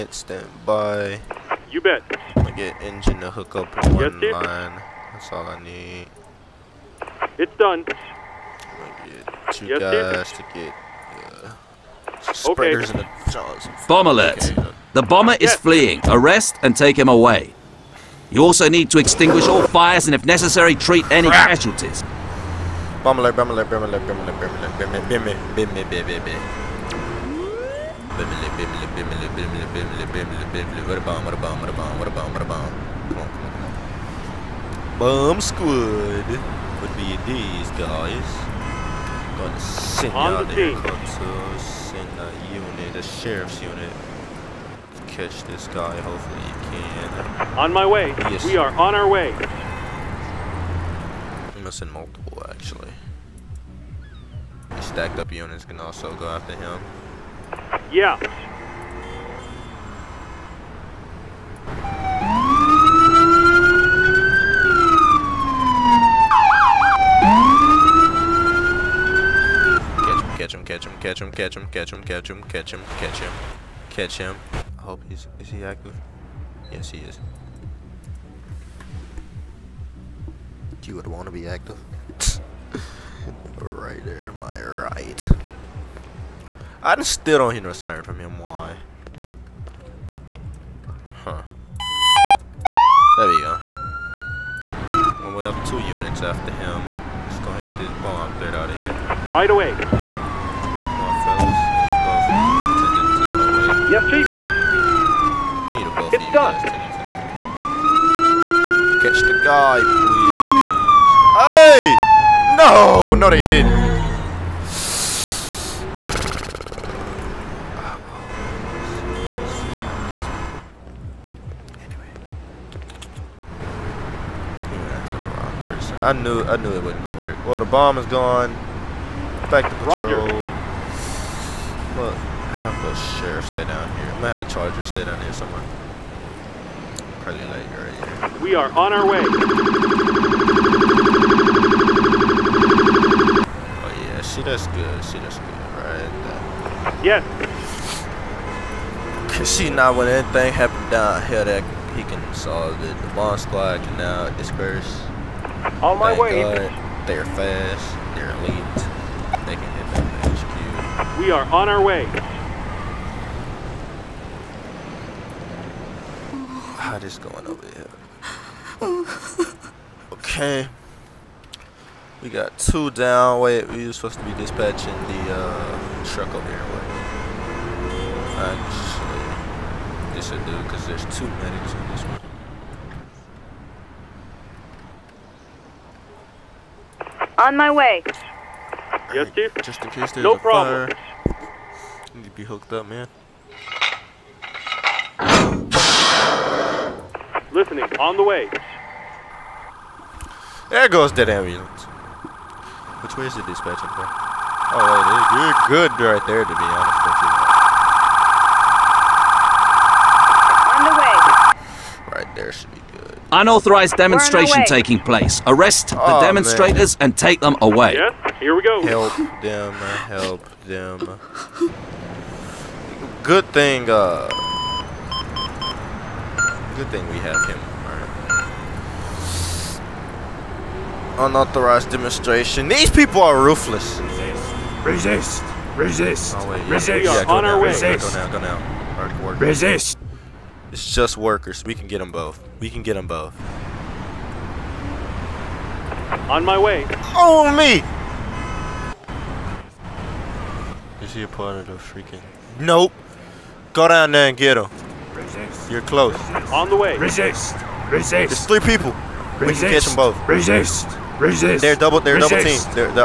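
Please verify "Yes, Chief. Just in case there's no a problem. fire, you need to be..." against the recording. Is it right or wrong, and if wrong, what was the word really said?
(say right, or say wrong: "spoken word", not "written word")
right.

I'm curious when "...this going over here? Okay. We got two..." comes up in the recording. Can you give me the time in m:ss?
2:46.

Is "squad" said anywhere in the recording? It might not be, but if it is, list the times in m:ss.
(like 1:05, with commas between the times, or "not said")
0:35, 2:33.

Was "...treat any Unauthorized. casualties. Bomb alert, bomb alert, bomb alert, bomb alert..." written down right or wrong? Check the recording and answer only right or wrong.
wrong.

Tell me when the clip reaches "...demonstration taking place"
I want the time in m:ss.
3:33.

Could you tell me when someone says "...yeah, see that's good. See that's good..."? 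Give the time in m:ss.
2:24.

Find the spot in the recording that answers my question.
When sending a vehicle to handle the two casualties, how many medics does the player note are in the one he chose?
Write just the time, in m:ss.
3:01.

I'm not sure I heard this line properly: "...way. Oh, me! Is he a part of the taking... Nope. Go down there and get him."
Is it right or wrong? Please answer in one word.
wrong.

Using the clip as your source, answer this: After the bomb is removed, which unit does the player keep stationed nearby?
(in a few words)
the charger.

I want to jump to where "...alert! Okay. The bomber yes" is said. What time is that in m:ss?
0:14.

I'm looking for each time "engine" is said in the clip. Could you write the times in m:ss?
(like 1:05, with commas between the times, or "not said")
0:02.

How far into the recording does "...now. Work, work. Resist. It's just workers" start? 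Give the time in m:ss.
3:58.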